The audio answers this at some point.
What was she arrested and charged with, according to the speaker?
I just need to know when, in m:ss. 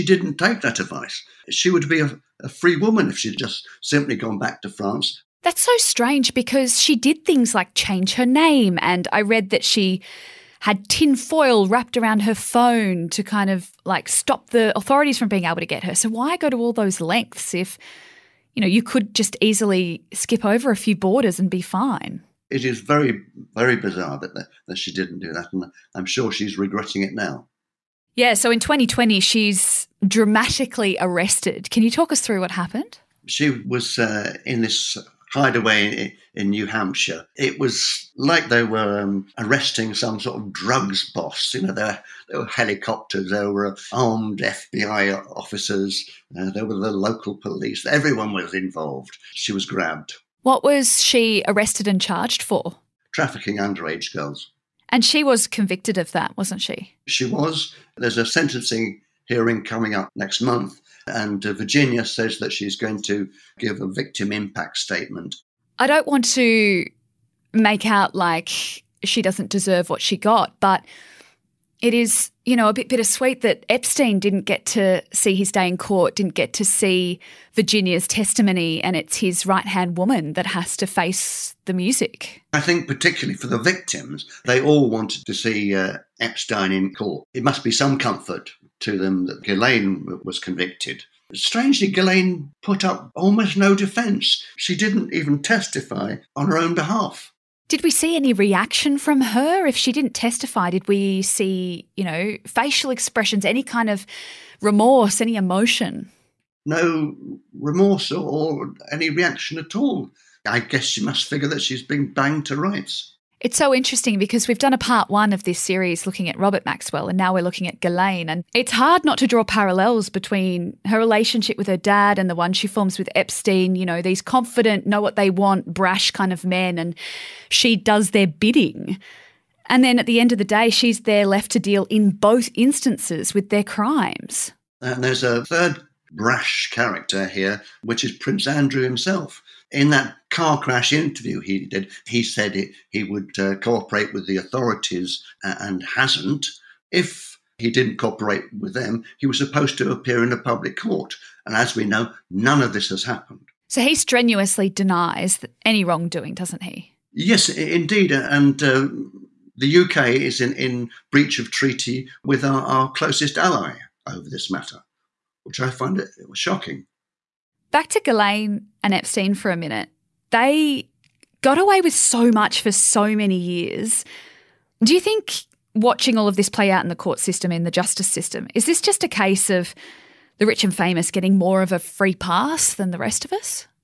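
0:53.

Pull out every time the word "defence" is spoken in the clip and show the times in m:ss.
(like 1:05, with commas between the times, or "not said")
1:33.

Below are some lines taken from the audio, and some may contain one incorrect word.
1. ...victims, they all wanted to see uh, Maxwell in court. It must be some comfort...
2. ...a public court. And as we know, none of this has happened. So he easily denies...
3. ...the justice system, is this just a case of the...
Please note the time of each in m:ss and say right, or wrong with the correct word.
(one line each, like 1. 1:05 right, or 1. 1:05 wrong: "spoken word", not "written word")
1. 1:23 wrong: "Epstein", not "Maxwell"
2. 2:30 wrong: "strenuously", not "easily"
3. 2:57 right.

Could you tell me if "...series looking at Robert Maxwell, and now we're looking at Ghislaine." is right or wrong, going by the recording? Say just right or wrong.
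right.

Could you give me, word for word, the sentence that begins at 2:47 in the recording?
Back to Ghislaine and Epstein for a minute.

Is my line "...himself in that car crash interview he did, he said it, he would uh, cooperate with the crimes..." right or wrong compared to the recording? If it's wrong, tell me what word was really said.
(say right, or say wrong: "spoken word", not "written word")
wrong: "authorities", not "crimes".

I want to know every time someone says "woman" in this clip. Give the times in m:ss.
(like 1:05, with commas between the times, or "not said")
0:02, 1:19.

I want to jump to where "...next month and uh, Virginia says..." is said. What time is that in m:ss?
1:00.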